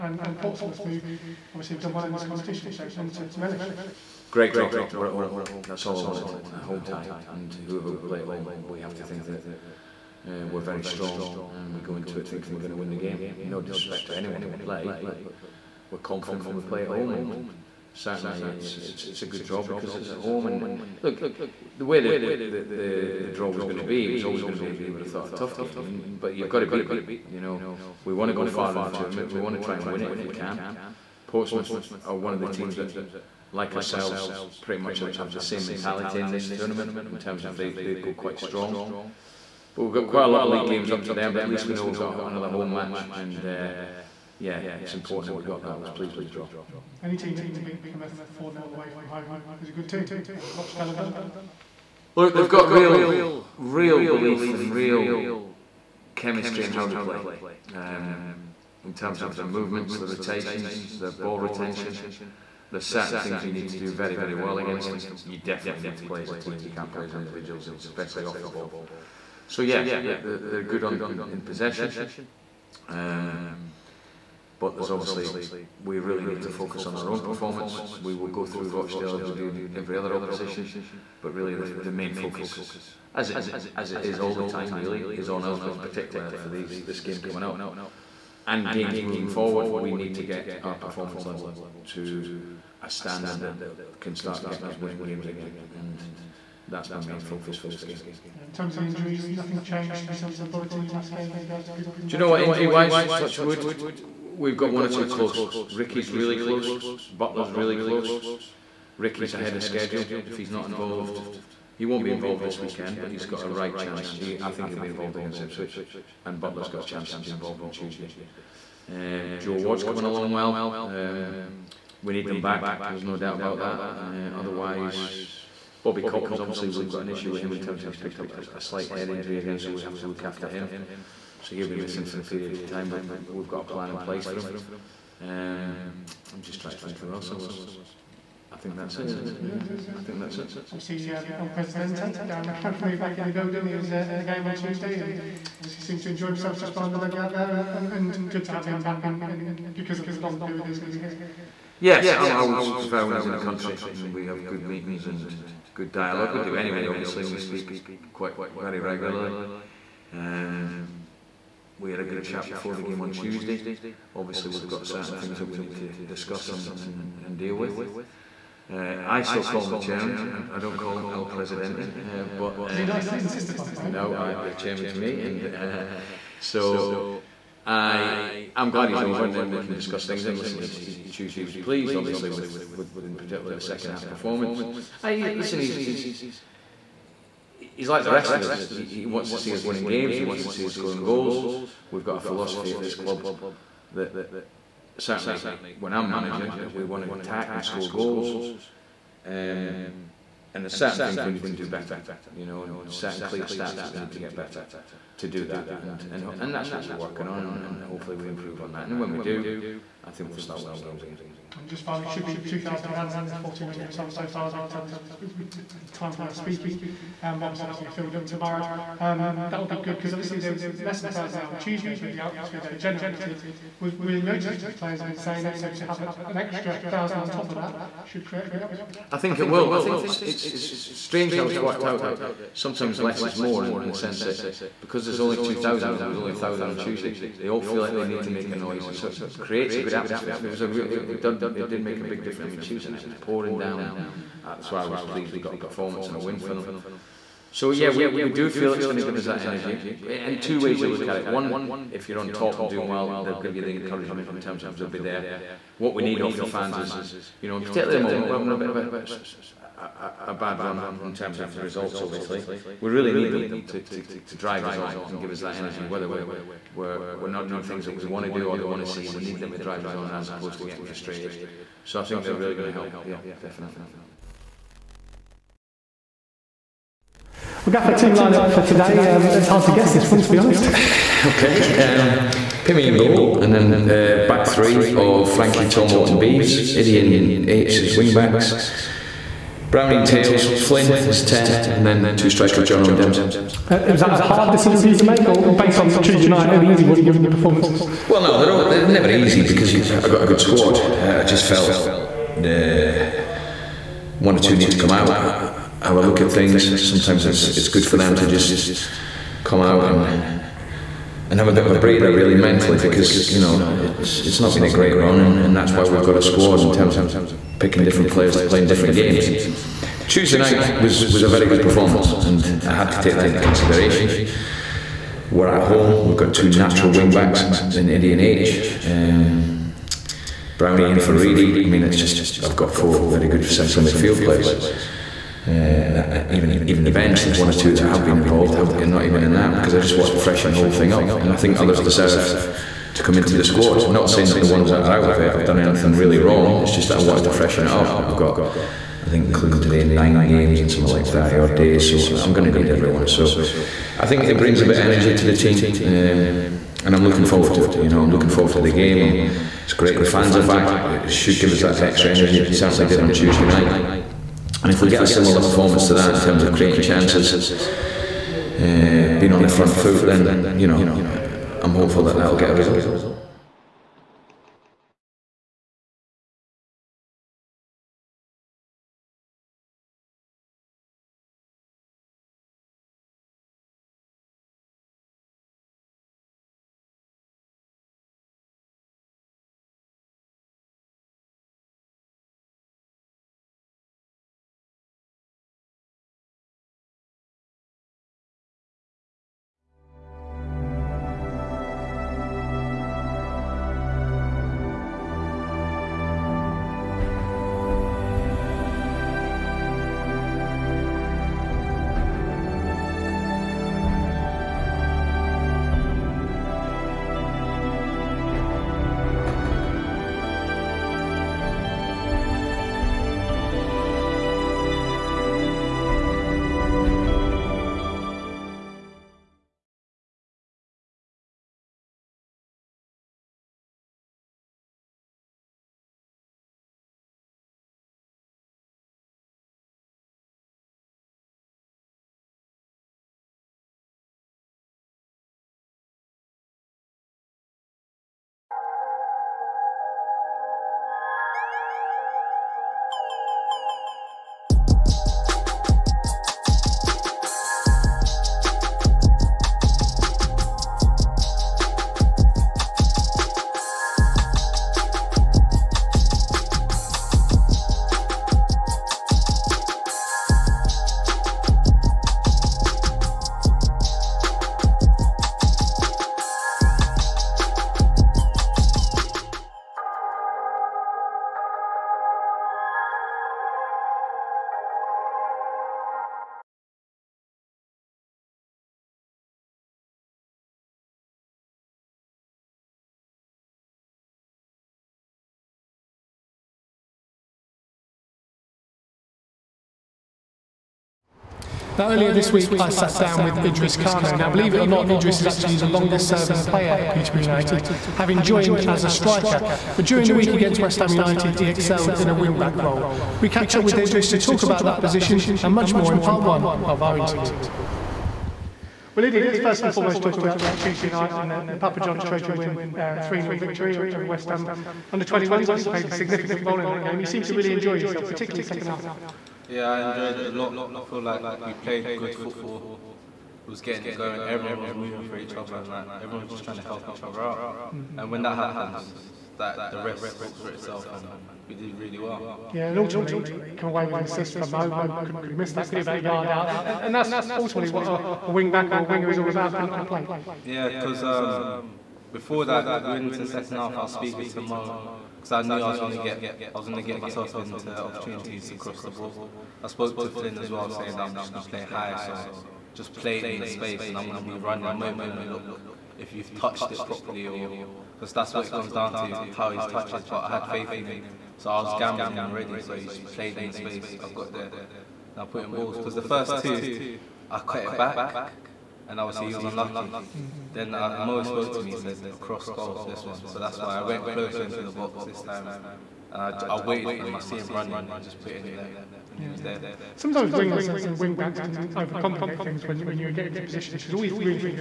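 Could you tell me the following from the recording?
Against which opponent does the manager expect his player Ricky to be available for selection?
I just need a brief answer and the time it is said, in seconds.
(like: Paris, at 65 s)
Ipswich, at 115 s.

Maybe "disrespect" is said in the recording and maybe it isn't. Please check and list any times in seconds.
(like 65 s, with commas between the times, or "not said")
13 s.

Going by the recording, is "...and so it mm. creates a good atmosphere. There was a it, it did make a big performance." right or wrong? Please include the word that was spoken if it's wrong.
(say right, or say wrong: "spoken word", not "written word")
wrong: "difference", not "performance".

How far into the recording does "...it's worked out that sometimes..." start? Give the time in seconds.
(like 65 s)
231 s.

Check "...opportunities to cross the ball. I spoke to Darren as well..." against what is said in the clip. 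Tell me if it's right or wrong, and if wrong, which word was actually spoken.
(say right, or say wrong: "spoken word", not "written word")
wrong: "Flynn", not "Darren".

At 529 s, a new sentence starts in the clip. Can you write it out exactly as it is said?
Yeah, I enjoyed it a lot.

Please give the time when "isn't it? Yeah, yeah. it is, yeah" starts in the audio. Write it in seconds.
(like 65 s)
139 s.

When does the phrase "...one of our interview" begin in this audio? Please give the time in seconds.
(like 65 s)
516 s.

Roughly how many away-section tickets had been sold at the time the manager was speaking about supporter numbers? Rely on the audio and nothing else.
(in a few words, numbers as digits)
1,400.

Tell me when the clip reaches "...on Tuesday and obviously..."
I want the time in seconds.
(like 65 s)
144 s.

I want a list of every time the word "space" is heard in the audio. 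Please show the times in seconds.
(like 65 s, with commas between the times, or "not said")
563 s, 573 s.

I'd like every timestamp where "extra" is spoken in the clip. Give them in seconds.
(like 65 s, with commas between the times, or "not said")
226 s, 361 s.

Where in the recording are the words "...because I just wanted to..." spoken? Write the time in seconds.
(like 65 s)
339 s.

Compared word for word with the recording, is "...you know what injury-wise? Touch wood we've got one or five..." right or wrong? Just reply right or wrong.
wrong.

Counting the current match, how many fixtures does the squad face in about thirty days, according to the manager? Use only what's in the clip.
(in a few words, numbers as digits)
9.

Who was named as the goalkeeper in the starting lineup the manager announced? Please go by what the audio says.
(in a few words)
Pimmy.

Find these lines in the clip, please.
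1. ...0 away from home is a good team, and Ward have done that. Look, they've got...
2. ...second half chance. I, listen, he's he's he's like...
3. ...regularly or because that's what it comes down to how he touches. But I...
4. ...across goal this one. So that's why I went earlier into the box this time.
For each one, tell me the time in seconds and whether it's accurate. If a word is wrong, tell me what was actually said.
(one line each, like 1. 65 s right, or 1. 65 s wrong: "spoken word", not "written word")
1. 48 s wrong: "Rochdale", not "Ward"
2. 183 s wrong: "performance", not "chance"
3. 566 s wrong: "properly", not "regularly"
4. 582 s wrong: "closer", not "earlier".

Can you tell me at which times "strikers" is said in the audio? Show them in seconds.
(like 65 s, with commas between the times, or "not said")
292 s, 508 s.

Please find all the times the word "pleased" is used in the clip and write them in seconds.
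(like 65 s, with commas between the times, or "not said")
45 s, 181 s, 245 s.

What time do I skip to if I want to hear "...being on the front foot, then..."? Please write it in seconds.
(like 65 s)
369 s.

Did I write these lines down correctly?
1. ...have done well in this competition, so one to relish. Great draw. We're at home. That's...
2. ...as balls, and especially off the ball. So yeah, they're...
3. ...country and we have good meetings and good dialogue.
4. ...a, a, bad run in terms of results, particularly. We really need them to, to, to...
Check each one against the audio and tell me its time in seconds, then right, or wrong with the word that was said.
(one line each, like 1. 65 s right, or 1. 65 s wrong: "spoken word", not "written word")
1. 1 s right
2. 67 s wrong: "individuals", not "balls"
3. 153 s right
4. 259 s wrong: "obviously", not "particularly".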